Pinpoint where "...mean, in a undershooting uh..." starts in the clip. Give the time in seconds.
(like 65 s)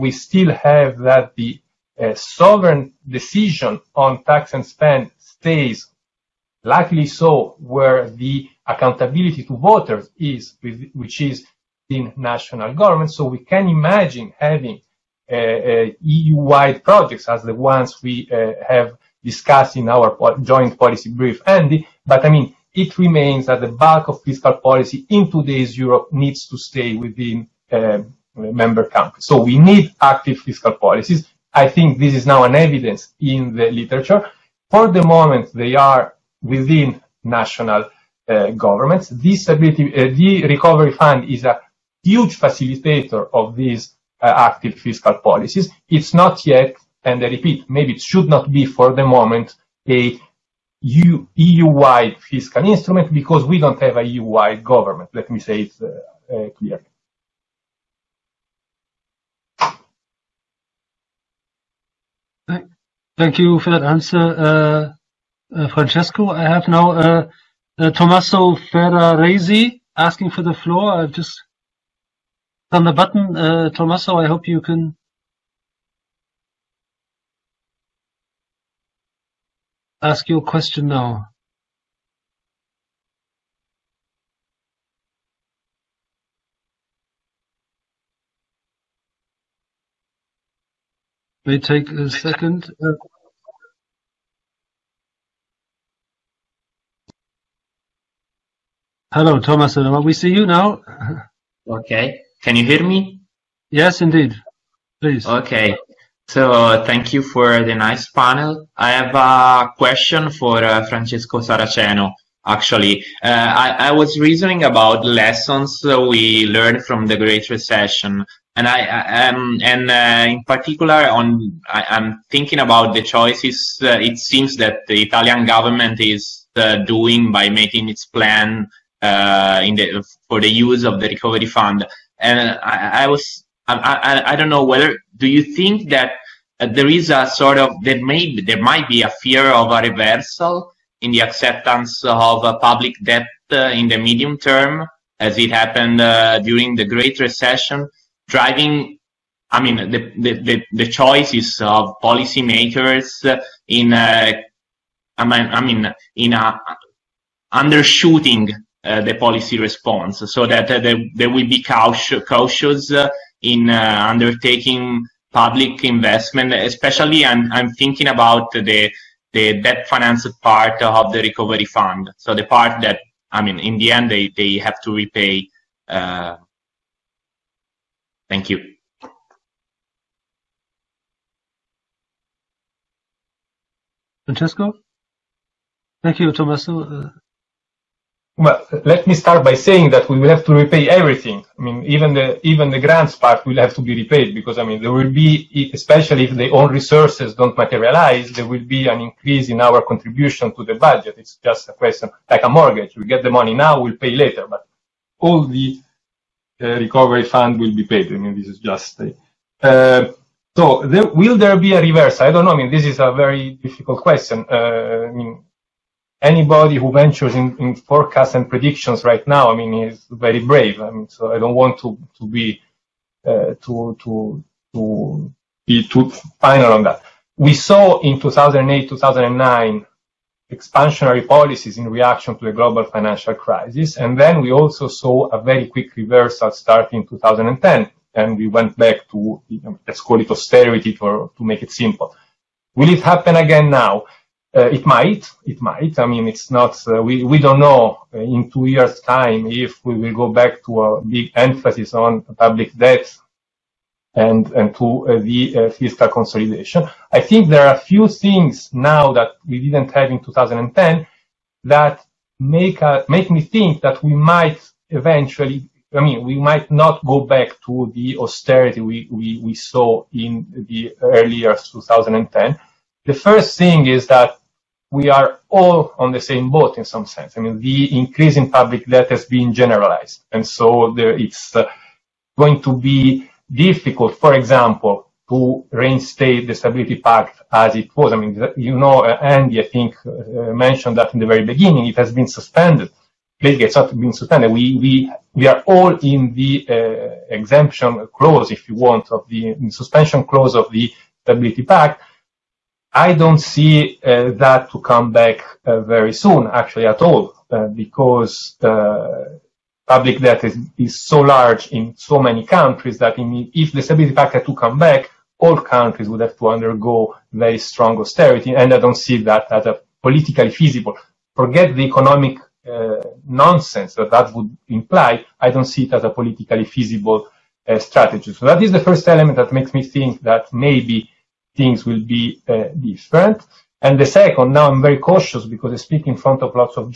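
155 s.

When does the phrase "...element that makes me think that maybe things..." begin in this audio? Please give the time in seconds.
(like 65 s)
329 s.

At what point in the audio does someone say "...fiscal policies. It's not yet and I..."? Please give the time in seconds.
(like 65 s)
44 s.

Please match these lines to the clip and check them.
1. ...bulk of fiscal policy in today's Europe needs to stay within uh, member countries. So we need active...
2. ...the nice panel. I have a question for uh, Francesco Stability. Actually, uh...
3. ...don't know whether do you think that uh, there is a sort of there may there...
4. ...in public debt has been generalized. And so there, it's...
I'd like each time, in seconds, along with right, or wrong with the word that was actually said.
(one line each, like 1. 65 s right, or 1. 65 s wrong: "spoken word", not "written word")
1. 23 s right
2. 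107 s wrong: "Saraceno", not "Stability"
3. 134 s right
4. 278 s right.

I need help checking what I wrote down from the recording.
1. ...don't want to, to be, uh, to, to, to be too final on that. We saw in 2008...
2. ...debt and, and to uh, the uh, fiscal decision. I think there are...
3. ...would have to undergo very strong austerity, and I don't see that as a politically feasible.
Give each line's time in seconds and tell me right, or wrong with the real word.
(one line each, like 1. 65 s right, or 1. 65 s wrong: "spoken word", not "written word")
1. 221 s right
2. 252 s wrong: "consolidation", not "decision"
3. 316 s right.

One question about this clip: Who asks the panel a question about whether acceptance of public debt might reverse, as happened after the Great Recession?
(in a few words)
Tommaso Ferraresi.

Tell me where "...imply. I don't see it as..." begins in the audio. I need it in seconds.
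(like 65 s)
324 s.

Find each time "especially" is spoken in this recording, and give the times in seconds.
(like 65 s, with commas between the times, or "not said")
166 s, 195 s.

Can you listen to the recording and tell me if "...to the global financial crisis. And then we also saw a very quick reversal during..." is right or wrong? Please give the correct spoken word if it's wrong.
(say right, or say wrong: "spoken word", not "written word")
wrong: "starting", not "during".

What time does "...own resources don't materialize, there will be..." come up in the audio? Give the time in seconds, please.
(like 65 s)
196 s.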